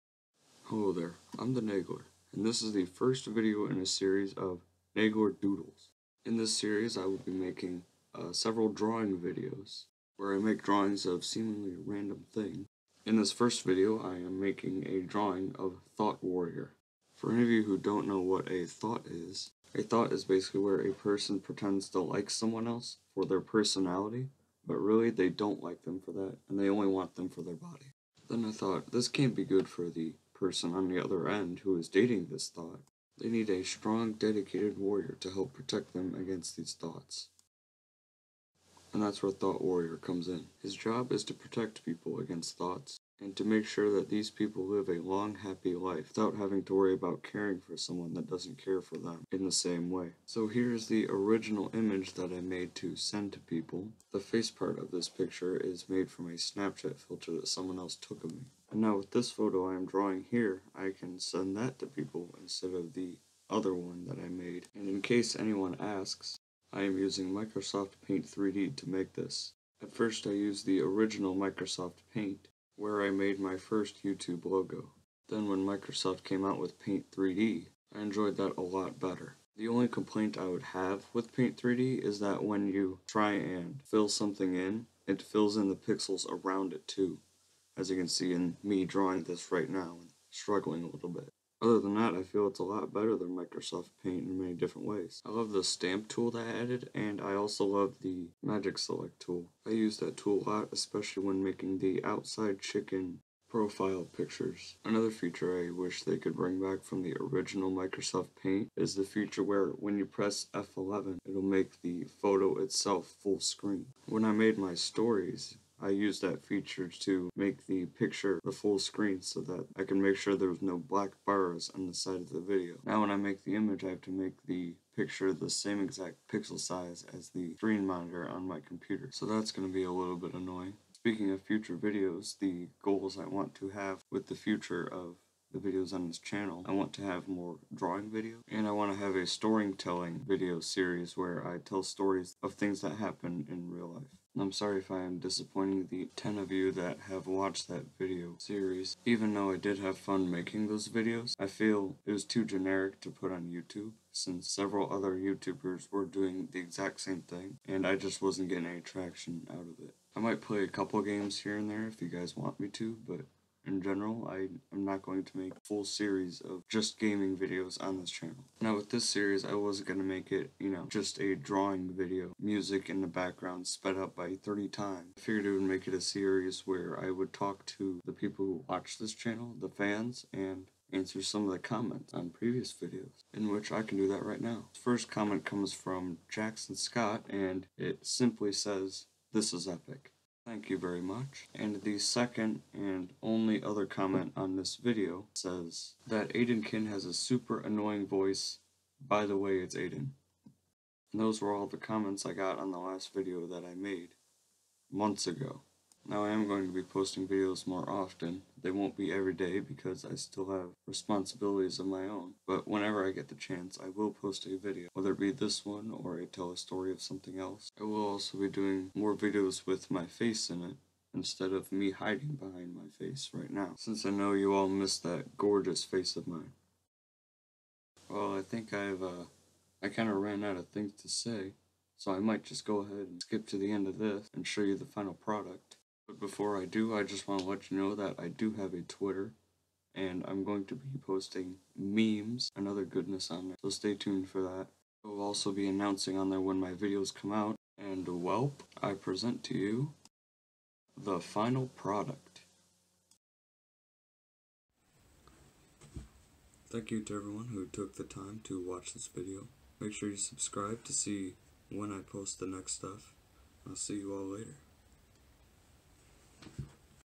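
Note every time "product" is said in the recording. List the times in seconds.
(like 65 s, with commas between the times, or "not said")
235 s, 251 s.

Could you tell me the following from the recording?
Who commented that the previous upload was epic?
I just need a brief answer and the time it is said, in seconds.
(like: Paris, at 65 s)
Jackson Scott, at 186 s.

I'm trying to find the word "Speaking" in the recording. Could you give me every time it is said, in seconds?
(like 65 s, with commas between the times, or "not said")
130 s.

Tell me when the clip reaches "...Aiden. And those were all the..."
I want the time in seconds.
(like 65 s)
199 s.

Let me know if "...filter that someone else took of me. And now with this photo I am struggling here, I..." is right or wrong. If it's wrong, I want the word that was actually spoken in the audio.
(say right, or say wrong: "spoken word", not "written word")
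wrong: "drawing", not "struggling".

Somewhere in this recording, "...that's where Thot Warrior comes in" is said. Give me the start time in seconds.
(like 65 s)
39 s.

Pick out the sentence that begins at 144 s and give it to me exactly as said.
I'm sorry if I am disappointing the 10 of you that have watched that video series.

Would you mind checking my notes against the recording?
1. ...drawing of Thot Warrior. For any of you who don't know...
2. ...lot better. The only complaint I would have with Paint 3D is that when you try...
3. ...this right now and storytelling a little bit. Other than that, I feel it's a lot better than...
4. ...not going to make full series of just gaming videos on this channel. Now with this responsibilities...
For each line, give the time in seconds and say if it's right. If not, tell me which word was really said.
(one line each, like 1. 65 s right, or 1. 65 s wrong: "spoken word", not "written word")
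1. 15 s right
2. 78 s right
3. 89 s wrong: "struggling", not "storytelling"
4. 164 s wrong: "series", not "responsibilities".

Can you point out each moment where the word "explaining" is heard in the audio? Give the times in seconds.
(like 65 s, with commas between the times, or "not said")
not said.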